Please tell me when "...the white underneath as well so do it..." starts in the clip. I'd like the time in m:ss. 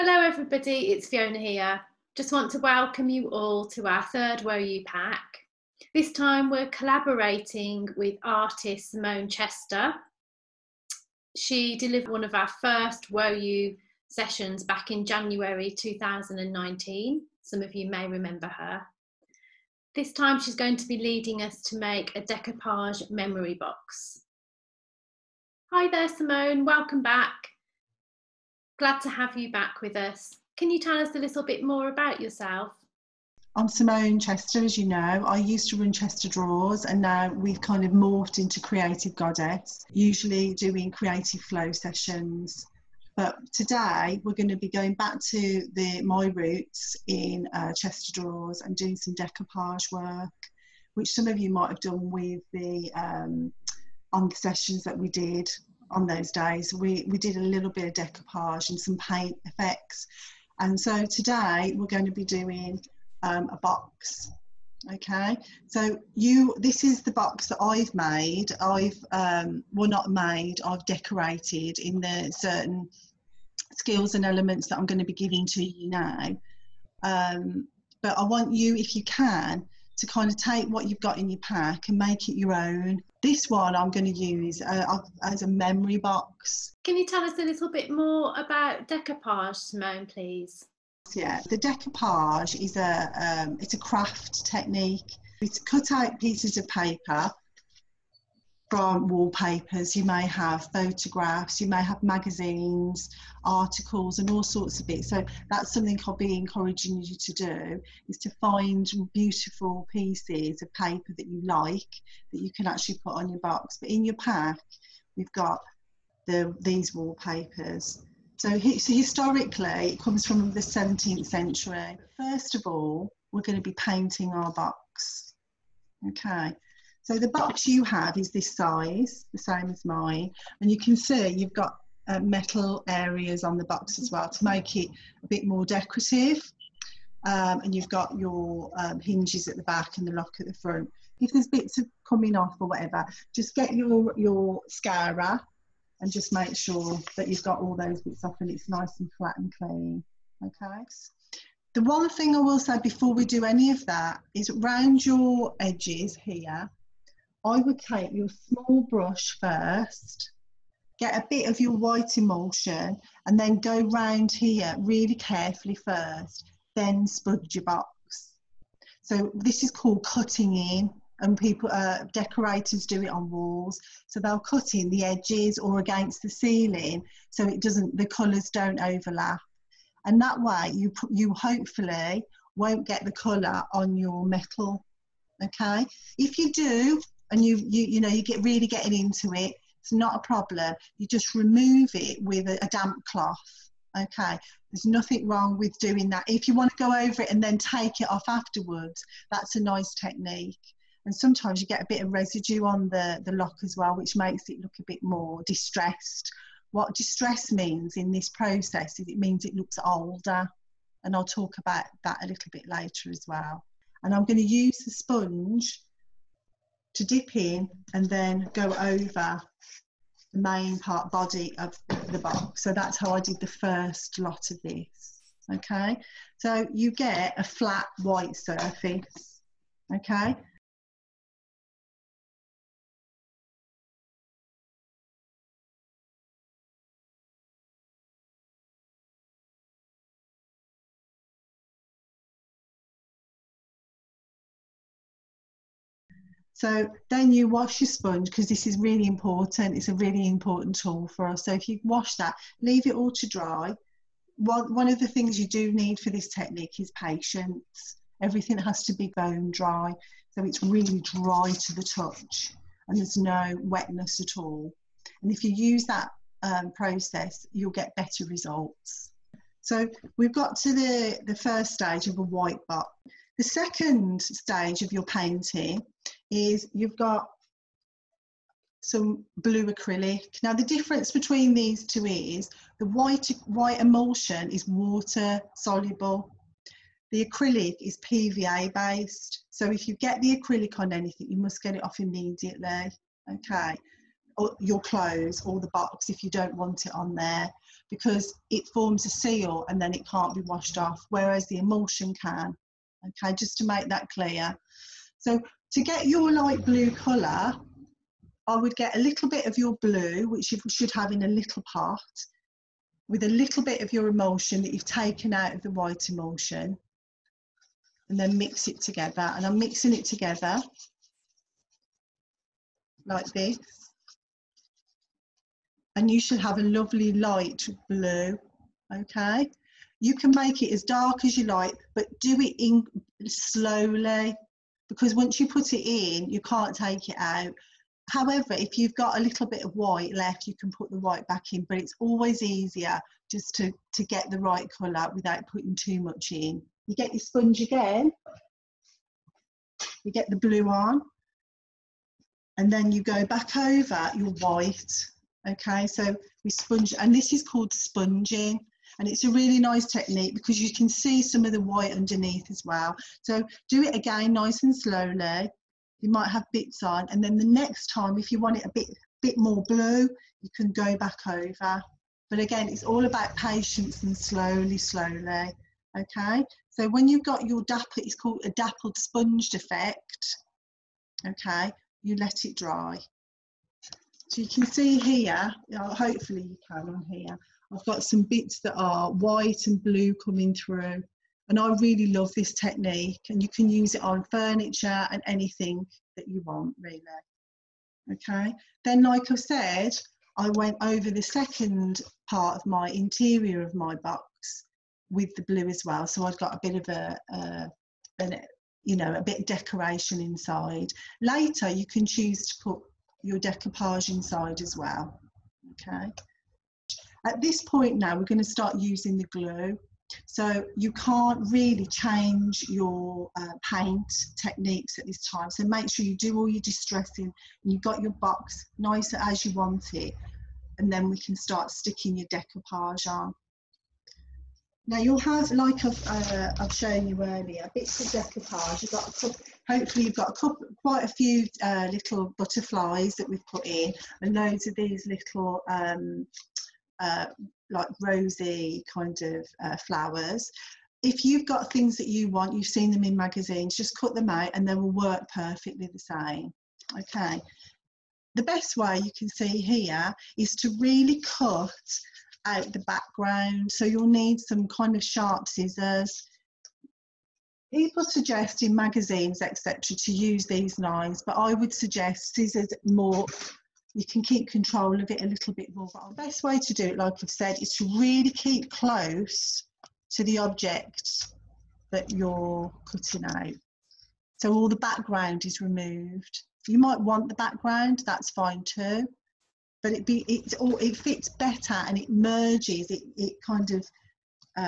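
6:01.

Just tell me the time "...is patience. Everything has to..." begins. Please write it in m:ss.
4:16.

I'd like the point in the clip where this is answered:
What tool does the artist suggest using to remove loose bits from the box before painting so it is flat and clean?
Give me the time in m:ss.
2:24.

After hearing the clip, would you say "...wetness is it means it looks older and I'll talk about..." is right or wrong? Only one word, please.
wrong.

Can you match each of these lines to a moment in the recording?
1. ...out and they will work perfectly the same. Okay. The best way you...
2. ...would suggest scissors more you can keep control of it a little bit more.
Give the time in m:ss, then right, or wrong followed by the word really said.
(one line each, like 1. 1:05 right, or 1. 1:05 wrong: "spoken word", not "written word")
1. 7:34 right
2. 7:51 right.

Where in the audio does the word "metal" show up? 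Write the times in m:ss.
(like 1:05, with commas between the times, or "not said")
2:12, 3:04.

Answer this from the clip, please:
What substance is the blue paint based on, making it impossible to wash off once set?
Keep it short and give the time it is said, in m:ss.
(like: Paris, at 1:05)
PVA, at 4:47.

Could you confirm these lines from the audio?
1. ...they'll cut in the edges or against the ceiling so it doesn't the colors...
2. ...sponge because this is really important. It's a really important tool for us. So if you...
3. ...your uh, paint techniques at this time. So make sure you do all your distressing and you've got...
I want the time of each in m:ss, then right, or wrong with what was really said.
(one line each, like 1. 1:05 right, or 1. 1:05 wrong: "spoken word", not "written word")
1. 2:54 right
2. 4:07 right
3. 7:02 right.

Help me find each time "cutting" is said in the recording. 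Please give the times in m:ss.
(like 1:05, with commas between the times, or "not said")
2:50, 8:02.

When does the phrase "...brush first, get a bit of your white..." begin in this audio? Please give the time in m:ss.
2:38.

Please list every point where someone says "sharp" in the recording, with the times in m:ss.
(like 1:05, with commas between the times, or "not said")
7:45.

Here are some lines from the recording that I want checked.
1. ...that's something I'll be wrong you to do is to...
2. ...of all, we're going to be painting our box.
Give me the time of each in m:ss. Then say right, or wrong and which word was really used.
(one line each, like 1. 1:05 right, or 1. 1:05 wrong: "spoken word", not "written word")
1. 1:45 wrong: "encouraging", not "wrong"
2. 2:02 right.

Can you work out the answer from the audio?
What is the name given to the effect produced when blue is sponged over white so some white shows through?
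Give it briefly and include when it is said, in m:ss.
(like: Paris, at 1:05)
dappled sponged effect, at 6:18.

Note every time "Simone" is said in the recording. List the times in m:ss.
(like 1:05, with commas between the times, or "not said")
0:08, 0:26, 0:33, 1:29.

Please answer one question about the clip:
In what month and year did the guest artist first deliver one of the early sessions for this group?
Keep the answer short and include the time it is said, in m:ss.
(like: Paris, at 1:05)
January 2019, at 0:15.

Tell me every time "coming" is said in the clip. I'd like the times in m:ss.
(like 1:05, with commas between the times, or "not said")
2:22, 6:30.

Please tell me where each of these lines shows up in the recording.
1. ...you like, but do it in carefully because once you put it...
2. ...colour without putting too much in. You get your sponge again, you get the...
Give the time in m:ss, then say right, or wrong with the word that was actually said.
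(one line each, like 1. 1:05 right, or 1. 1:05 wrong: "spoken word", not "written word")
1. 5:31 wrong: "slowly", not "carefully"
2. 5:44 right.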